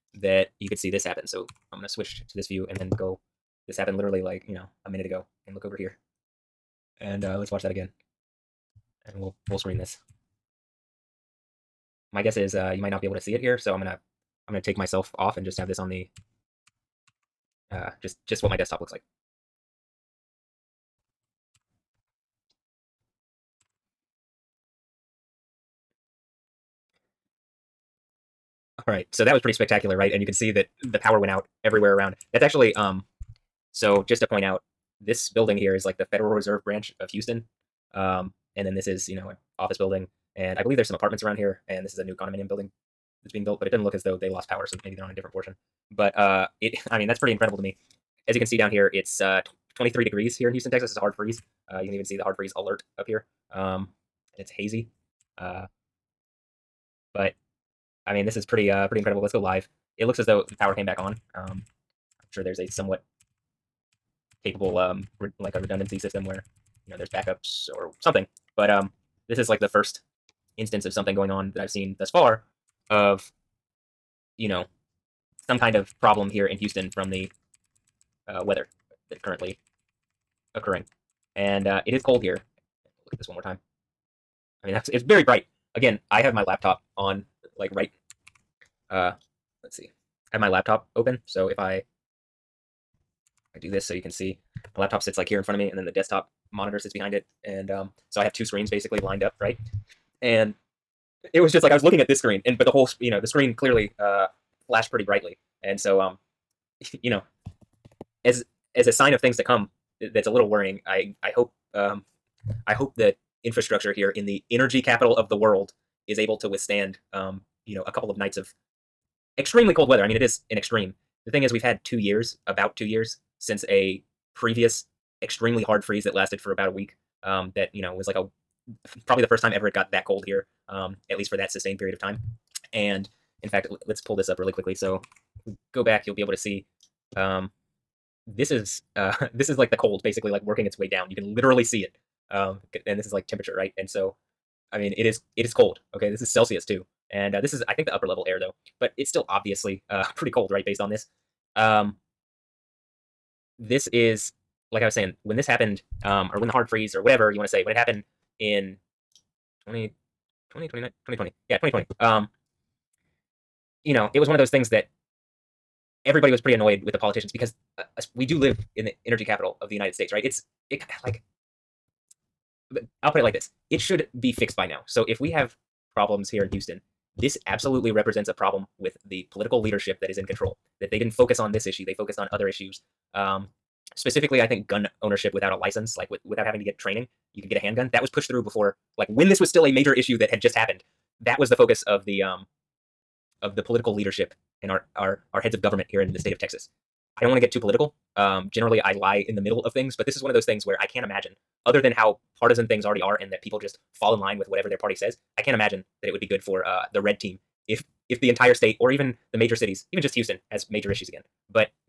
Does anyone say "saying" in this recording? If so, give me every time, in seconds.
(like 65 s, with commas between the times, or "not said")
154 s.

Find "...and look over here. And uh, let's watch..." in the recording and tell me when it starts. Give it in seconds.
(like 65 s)
5 s.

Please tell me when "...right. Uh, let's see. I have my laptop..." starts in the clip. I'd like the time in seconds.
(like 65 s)
87 s.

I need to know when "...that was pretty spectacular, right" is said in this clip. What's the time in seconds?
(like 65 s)
29 s.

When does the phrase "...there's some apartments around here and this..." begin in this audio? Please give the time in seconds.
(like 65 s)
40 s.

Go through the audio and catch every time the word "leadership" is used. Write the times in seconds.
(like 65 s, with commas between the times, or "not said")
179 s, 193 s.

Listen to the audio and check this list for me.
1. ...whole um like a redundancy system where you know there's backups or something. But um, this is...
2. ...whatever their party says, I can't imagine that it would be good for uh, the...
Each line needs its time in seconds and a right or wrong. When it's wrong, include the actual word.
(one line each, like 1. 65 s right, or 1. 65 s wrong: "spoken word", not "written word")
1. 64 s wrong: "capable", not "whole"
2. 204 s right.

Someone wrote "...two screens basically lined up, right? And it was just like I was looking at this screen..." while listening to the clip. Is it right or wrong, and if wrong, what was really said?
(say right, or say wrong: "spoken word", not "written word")
right.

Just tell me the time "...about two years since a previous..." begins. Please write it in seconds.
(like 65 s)
122 s.